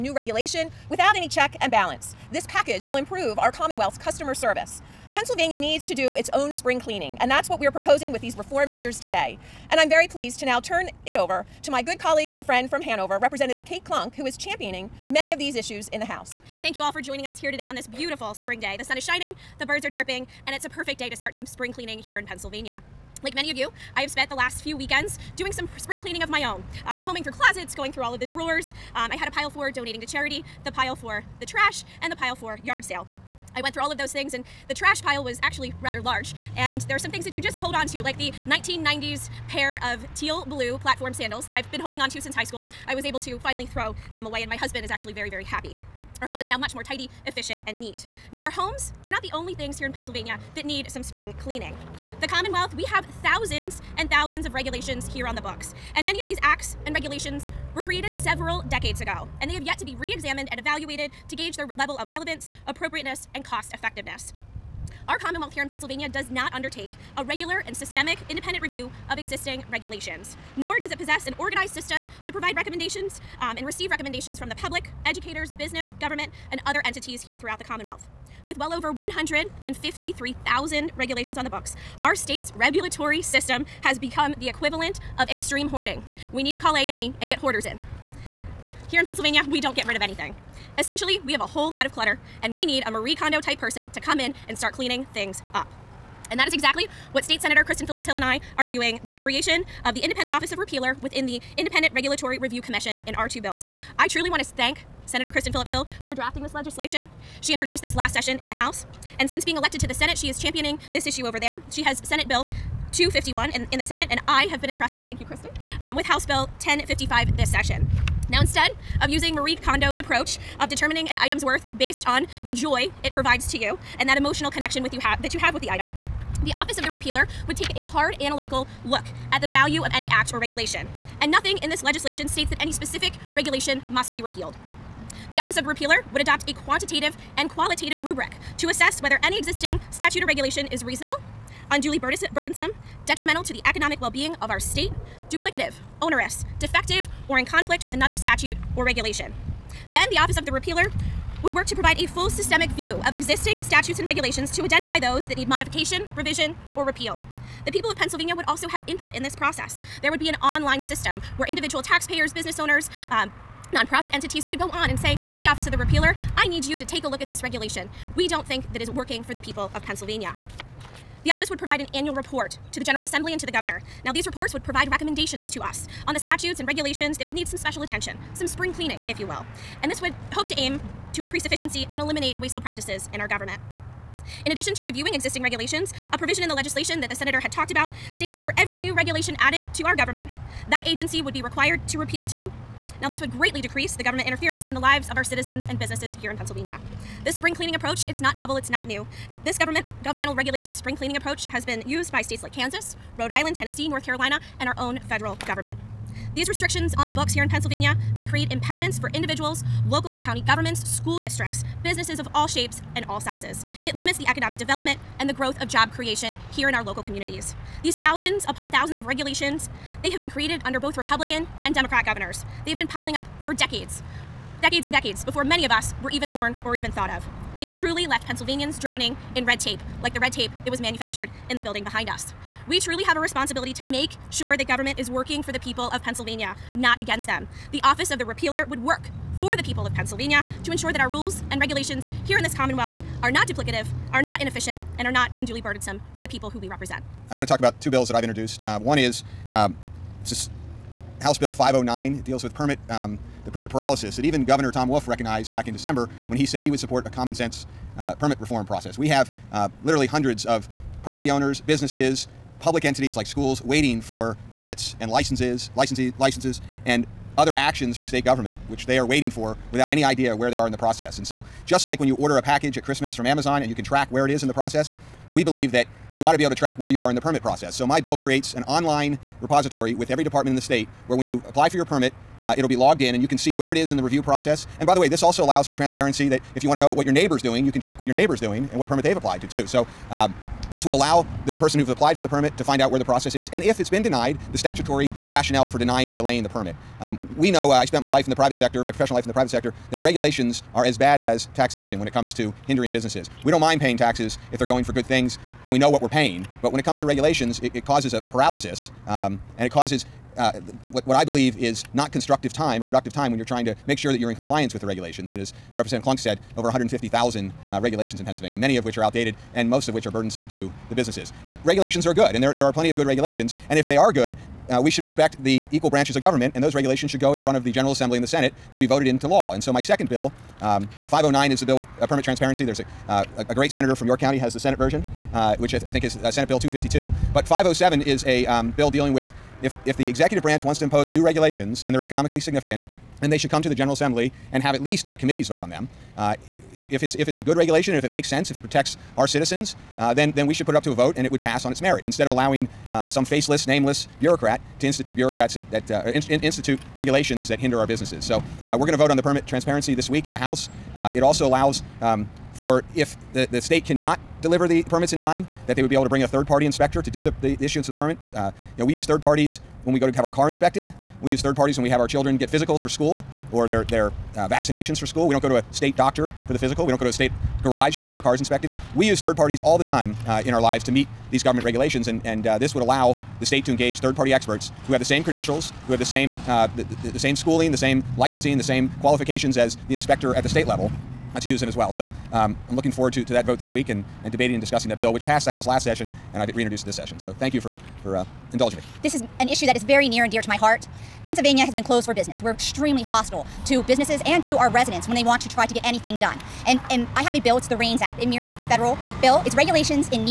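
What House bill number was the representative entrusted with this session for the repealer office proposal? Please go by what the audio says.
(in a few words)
1055.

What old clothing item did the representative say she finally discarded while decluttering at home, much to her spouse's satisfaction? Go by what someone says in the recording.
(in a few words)
teal blue platform sandals.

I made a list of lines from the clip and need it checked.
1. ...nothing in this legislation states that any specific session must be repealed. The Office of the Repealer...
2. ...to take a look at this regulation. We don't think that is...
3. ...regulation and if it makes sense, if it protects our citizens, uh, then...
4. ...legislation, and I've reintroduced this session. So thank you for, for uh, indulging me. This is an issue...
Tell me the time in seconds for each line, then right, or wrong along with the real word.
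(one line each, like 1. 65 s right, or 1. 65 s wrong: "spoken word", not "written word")
1. 131 s wrong: "regulation", not "session"
2. 166 s right
3. 347 s right
4. 395 s wrong: "session", not "legislation".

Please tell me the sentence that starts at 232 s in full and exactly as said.
We truly have a responsibility to make sure the government is working for the people of Pennsylvania, not against them.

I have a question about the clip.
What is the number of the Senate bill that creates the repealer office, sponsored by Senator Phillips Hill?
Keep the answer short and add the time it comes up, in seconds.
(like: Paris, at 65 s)
251, at 112 s.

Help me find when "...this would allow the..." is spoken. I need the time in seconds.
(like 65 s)
382 s.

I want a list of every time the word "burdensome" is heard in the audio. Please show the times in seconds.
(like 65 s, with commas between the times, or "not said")
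141 s, 245 s, 320 s.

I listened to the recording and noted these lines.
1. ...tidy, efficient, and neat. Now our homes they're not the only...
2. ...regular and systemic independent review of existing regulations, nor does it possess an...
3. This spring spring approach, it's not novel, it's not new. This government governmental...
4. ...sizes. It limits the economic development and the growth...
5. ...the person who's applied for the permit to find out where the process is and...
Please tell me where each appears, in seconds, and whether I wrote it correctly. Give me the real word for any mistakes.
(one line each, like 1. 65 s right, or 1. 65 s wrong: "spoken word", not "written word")
1. 46 s right
2. 67 s right
3. 197 s wrong: "cleaning", not "spring"
4. 213 s right
5. 291 s right.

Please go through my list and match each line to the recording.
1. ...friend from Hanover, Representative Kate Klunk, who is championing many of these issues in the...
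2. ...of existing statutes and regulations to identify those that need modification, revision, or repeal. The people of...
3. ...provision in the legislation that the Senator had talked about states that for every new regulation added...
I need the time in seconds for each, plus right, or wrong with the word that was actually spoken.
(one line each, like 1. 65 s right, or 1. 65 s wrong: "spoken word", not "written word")
1. 12 s right
2. 153 s right
3. 186 s right.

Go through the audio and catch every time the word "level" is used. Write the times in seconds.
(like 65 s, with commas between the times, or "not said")
61 s, 390 s.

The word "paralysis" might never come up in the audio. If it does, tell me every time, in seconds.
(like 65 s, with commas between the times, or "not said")
253 s, 308 s.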